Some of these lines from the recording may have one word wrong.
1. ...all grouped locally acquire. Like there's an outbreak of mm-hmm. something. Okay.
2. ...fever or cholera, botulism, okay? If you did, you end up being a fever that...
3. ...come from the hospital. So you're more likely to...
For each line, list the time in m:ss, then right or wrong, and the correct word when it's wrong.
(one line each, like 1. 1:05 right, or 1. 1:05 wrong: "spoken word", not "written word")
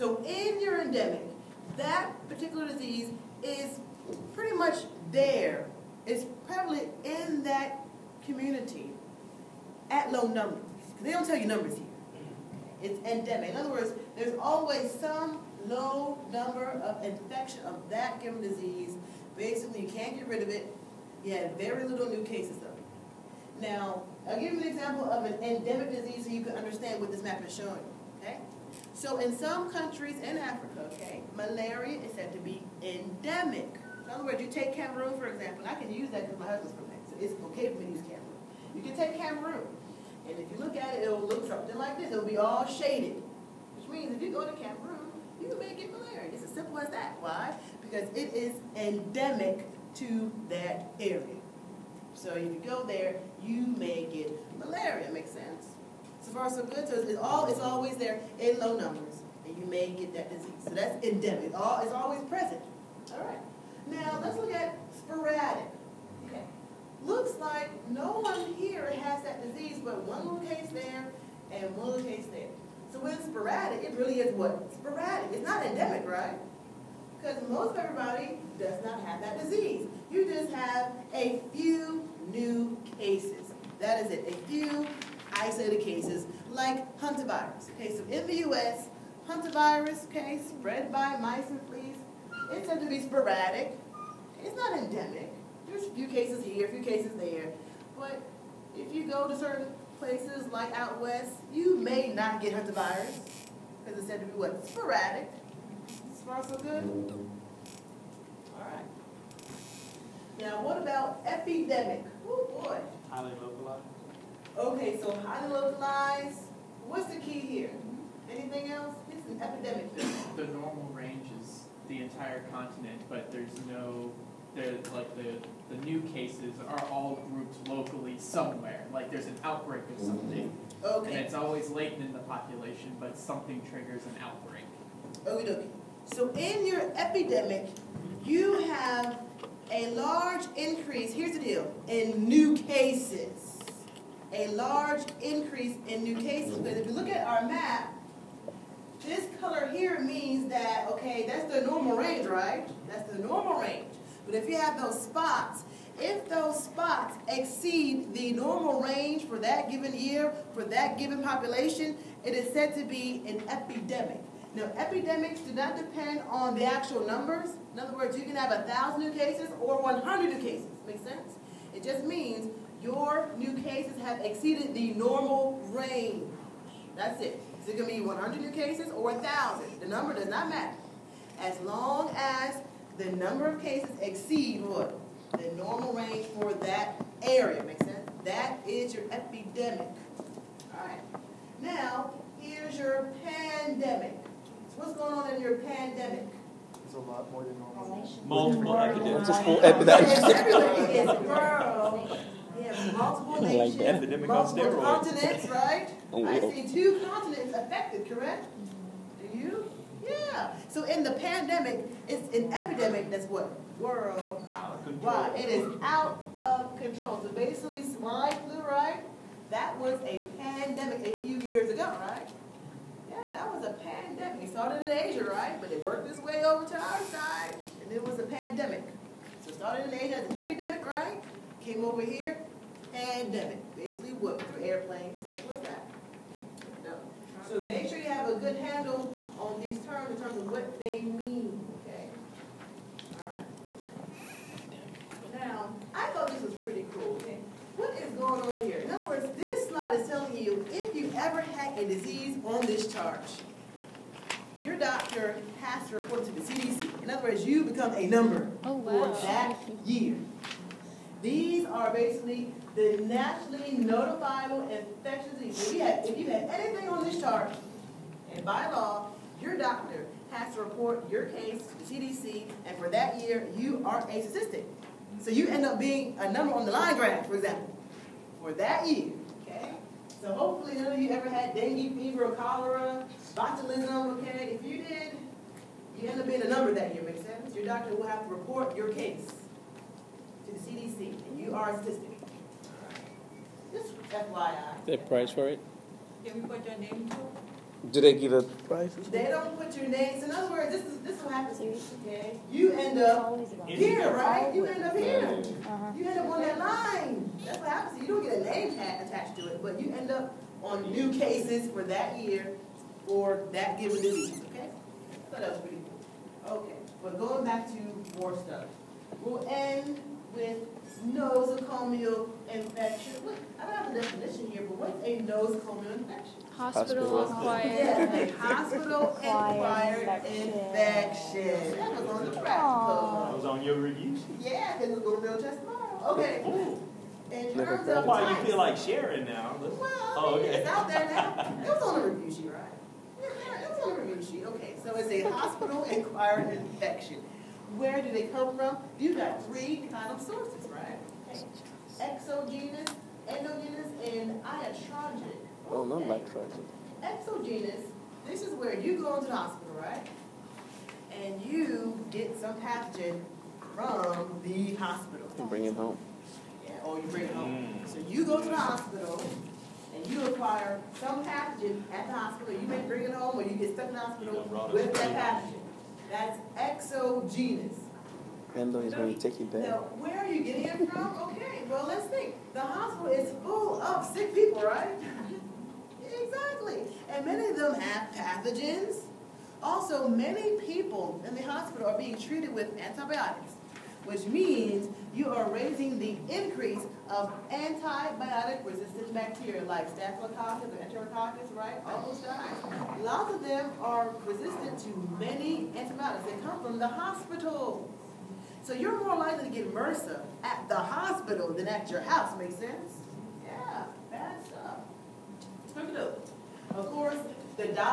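1. 2:06 wrong: "somewhere", not "acquire"
2. 4:41 wrong: "number", not "fever"
3. 6:46 right.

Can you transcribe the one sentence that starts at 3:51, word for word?
Came over here, pandemic, basically what, for airplanes, stuff like that.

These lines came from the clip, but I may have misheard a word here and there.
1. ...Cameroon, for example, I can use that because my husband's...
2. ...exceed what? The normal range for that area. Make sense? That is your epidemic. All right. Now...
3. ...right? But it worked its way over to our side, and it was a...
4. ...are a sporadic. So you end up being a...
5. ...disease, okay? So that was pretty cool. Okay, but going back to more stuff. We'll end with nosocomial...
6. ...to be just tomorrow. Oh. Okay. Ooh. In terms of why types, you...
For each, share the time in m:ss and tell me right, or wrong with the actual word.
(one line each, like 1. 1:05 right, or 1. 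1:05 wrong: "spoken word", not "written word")
1. 0:34 right
2. 3:04 right
3. 3:45 right
4. 4:33 wrong: "statistic", not "sporadic"
5. 5:14 right
6. 5:35 right.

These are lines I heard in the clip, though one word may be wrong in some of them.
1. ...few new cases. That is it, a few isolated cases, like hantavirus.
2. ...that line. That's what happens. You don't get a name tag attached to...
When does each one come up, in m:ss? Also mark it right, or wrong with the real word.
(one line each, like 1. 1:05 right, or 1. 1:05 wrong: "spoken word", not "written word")
1. 1:21 right
2. 5:06 right.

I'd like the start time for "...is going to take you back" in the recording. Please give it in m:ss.
6:18.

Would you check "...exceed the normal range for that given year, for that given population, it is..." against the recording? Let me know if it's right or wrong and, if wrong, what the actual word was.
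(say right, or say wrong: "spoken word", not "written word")
right.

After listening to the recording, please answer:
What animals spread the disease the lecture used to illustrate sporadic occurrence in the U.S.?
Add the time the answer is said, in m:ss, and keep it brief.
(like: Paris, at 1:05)
Mice, at 1:31.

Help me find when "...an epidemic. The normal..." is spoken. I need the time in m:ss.
1:59.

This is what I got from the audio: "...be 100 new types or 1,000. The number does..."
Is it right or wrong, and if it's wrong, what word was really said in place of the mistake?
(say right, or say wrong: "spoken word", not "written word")
wrong: "cases", not "types".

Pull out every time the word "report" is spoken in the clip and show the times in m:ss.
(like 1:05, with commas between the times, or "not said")
4:15, 4:30, 4:48.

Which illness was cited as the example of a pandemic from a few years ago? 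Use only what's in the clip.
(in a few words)
Swine flu.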